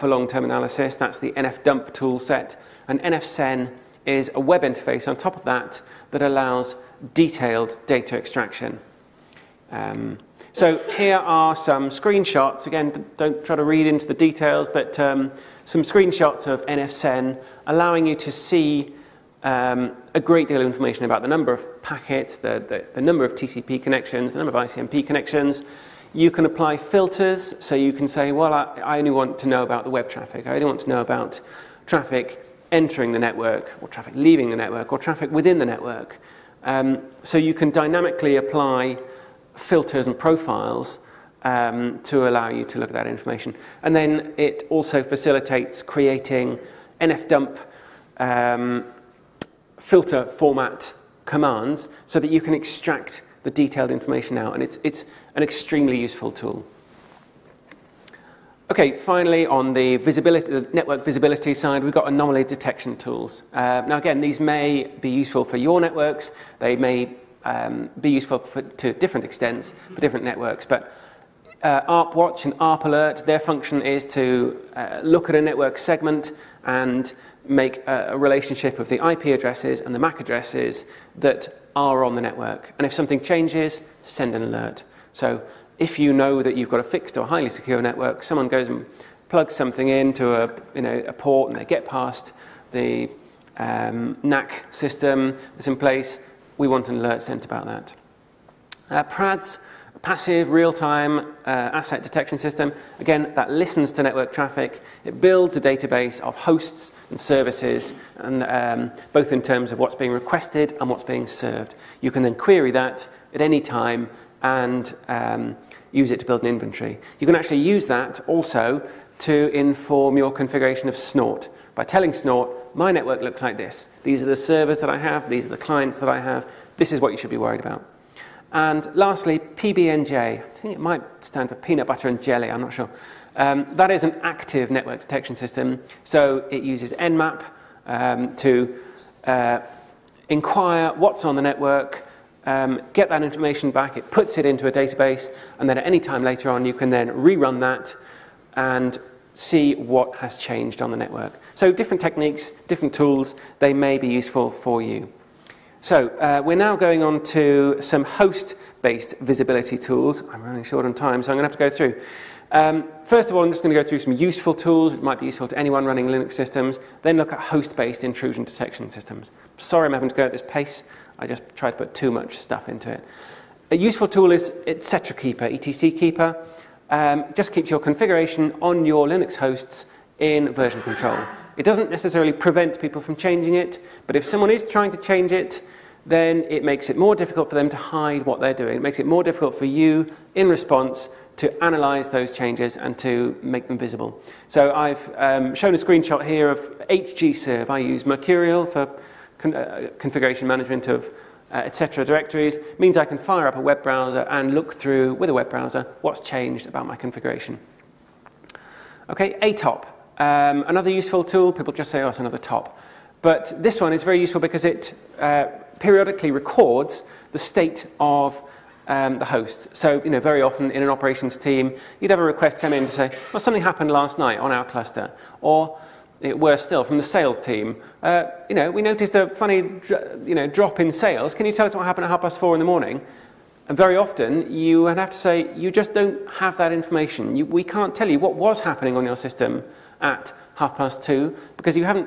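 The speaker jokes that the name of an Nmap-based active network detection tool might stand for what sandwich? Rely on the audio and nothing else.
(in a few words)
peanut butter and jelly.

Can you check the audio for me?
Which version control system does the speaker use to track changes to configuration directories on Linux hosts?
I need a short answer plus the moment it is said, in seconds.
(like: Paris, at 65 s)
Mercurial, at 198 s.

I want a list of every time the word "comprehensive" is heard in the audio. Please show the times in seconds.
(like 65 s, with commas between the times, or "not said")
not said.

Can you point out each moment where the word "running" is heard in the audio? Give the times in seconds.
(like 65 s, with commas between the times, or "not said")
160 s, 165 s.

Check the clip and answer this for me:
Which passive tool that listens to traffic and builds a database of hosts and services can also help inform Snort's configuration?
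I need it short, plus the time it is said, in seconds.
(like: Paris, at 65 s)
PRADS, at 99 s.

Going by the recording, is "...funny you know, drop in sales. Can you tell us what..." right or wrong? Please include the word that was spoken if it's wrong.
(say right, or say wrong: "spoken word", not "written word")
right.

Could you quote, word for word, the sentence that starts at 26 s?
You can apply filters, so you can say, well, I, I only want to know about the web traffic.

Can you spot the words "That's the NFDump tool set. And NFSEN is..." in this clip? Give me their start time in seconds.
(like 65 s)
0 s.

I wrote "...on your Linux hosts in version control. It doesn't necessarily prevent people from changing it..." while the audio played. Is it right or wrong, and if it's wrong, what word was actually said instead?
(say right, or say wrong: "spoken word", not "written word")
right.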